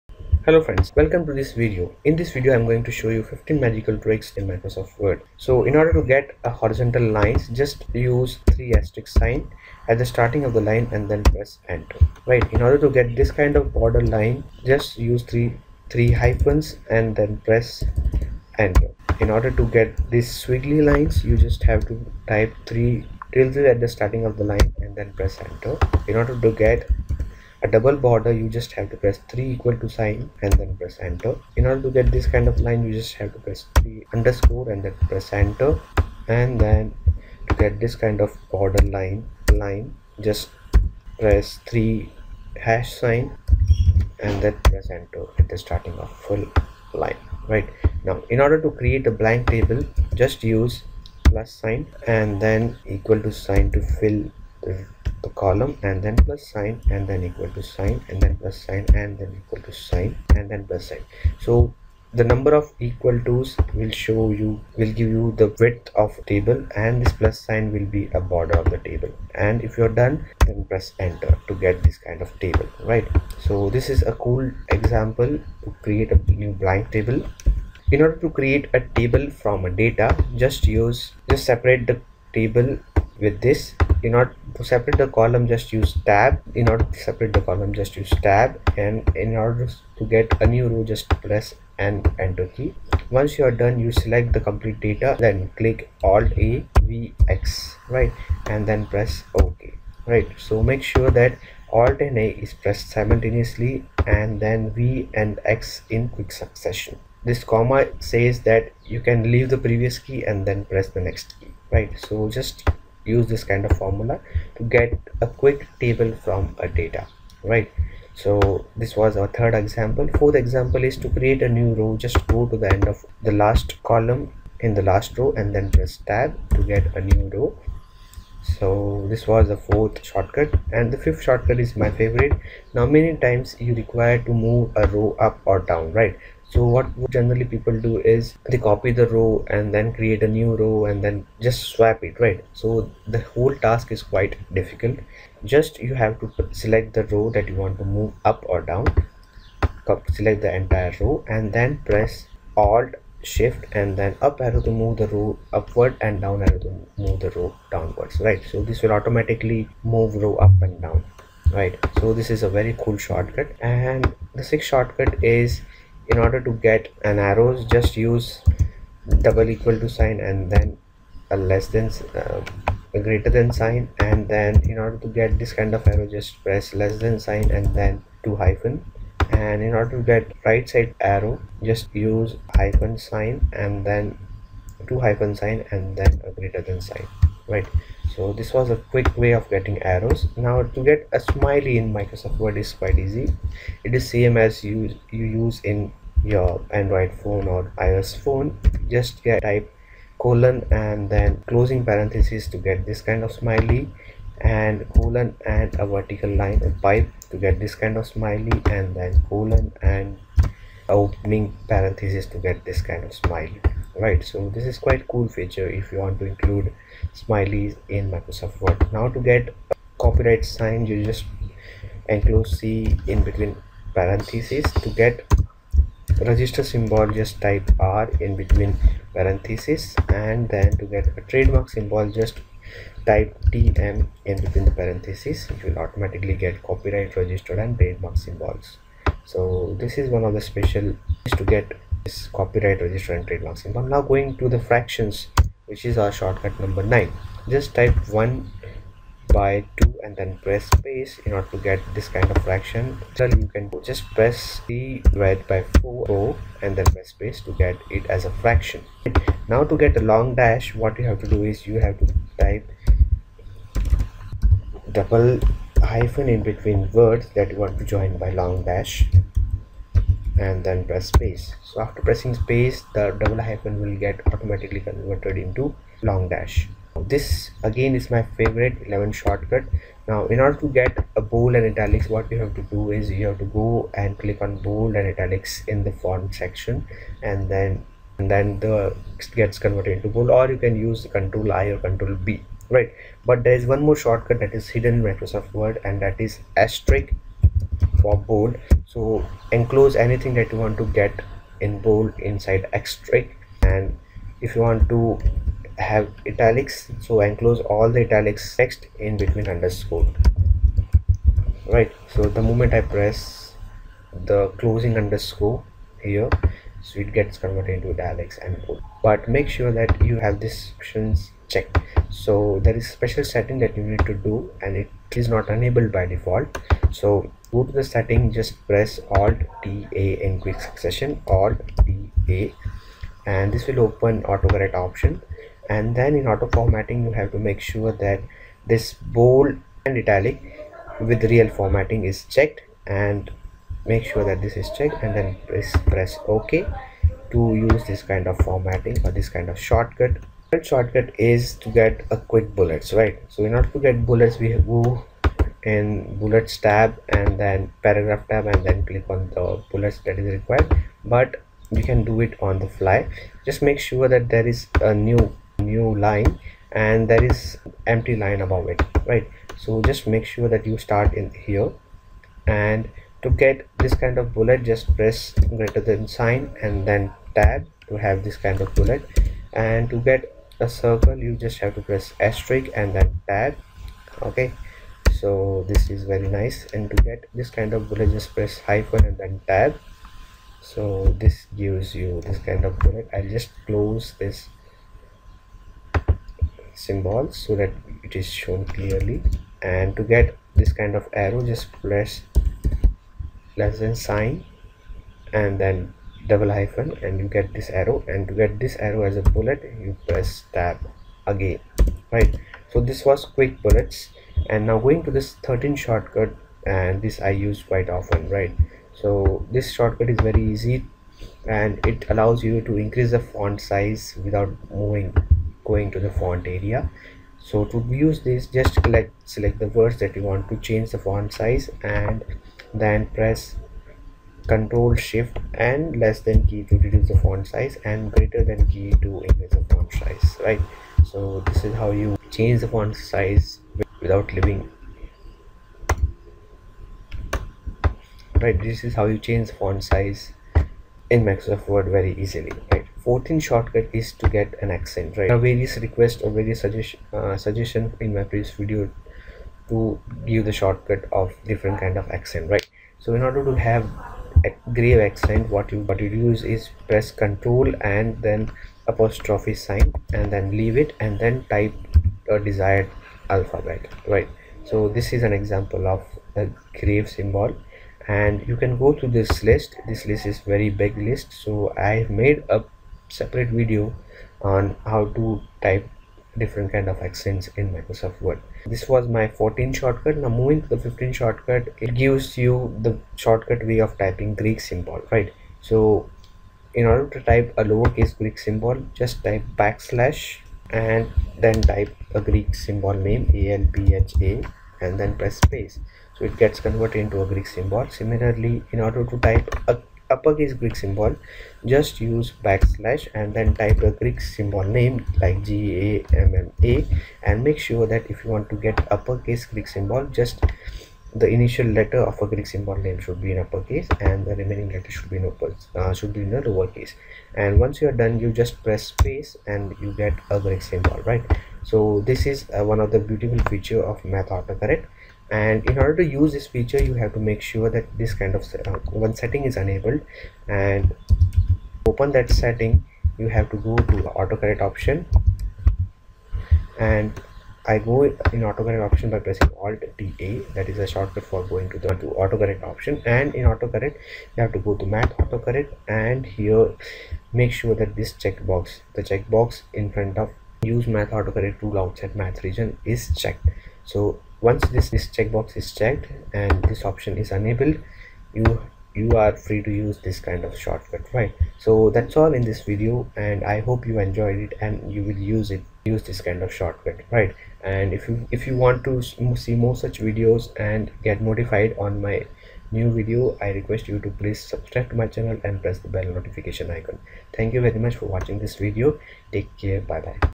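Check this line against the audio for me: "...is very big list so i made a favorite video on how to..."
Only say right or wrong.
wrong.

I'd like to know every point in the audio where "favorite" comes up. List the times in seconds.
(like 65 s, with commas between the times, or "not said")
131 s, 278 s.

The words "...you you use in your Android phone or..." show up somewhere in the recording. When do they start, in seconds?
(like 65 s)
194 s.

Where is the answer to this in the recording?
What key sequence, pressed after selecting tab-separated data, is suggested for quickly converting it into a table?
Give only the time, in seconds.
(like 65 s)
96 s.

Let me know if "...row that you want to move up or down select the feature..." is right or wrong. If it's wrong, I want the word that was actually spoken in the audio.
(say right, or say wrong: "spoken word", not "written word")
wrong: "entire", not "feature".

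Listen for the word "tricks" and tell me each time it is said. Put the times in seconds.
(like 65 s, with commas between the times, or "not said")
3 s.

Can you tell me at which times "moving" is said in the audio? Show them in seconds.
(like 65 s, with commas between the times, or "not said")
424 s, 490 s.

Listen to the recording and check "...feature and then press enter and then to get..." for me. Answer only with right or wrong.
wrong.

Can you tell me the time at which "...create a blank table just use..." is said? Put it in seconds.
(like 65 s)
48 s.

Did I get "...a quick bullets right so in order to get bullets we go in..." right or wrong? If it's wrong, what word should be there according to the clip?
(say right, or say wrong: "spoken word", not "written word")
right.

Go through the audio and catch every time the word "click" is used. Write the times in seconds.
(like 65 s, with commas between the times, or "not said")
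95 s, 284 s, 358 s.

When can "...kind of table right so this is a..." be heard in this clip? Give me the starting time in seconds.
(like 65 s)
71 s.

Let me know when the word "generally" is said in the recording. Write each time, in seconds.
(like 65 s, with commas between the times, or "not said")
137 s.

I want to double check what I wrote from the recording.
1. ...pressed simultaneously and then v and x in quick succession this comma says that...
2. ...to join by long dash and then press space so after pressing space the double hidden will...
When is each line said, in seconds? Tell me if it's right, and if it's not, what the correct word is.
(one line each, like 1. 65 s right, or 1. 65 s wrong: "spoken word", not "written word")
1. 102 s right
2. 267 s wrong: "hyphen", not "hidden".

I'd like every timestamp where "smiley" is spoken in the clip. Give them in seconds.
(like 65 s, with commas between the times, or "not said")
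191 s, 203 s, 208 s, 213 s, 217 s.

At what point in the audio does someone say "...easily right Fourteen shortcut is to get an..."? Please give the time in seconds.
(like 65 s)
452 s.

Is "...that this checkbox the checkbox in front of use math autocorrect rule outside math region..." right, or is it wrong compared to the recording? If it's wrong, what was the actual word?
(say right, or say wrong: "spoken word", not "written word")
right.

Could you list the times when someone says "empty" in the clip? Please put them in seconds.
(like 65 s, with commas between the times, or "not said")
367 s.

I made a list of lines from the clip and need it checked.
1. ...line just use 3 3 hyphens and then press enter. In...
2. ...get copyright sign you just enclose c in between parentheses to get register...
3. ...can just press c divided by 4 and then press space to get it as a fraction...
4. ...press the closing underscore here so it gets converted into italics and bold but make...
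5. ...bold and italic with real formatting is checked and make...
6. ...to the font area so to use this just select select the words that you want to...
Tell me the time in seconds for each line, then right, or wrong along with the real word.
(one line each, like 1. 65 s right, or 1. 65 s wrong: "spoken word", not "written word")
1. 14 s right
2. 219 s right
3. 253 s right
4. 312 s right
5. 338 s right
6. 425 s right.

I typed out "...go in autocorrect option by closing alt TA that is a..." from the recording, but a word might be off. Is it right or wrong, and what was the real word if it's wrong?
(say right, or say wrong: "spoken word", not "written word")
wrong: "pressing", not "closing".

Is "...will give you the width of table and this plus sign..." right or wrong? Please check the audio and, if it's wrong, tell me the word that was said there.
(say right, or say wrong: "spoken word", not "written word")
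right.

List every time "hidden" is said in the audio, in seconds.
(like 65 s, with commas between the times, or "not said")
294 s.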